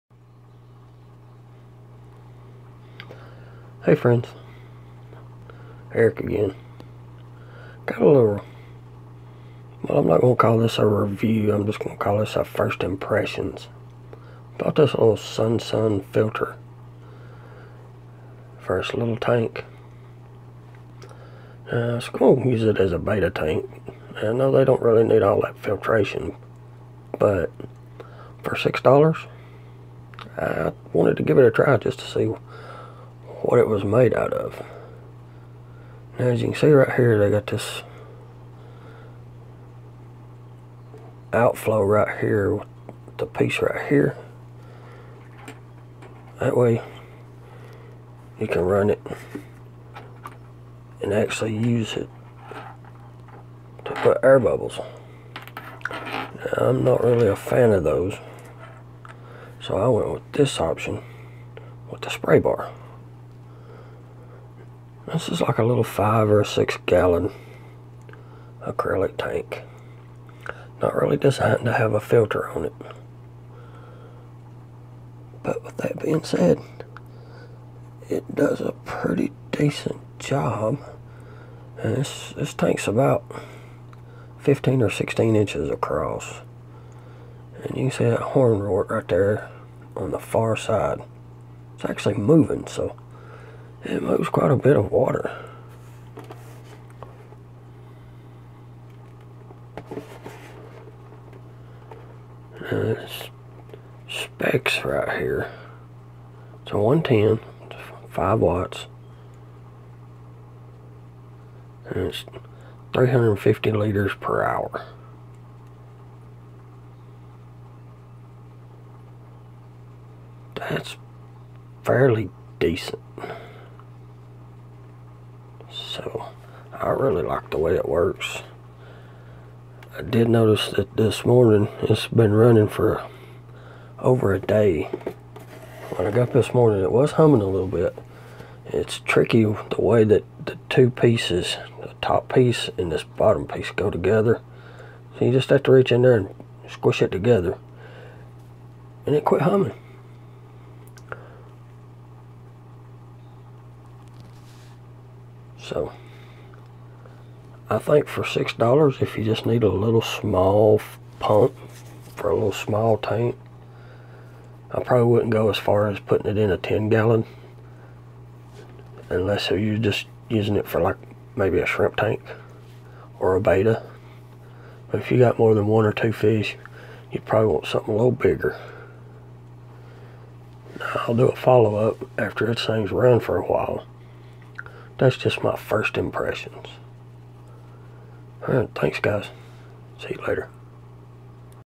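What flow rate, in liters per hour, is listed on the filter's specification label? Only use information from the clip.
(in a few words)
350 liters per hour.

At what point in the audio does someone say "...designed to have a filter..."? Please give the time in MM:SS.
01:11.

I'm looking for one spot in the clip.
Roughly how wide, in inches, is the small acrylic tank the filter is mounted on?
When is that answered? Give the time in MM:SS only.
01:24.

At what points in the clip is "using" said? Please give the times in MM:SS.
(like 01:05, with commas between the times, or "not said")
02:50.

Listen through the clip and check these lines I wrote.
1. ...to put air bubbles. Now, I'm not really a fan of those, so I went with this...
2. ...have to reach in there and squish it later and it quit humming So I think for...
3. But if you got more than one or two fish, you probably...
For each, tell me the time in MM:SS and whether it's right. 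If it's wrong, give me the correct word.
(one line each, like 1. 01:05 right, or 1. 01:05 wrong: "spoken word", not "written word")
1. 00:53 right
2. 02:25 wrong: "together", not "later"
3. 02:54 right.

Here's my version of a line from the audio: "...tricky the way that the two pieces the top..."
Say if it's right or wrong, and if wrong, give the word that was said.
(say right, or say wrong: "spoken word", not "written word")
right.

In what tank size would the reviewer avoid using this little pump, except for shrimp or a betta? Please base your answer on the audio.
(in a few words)
10 gallon.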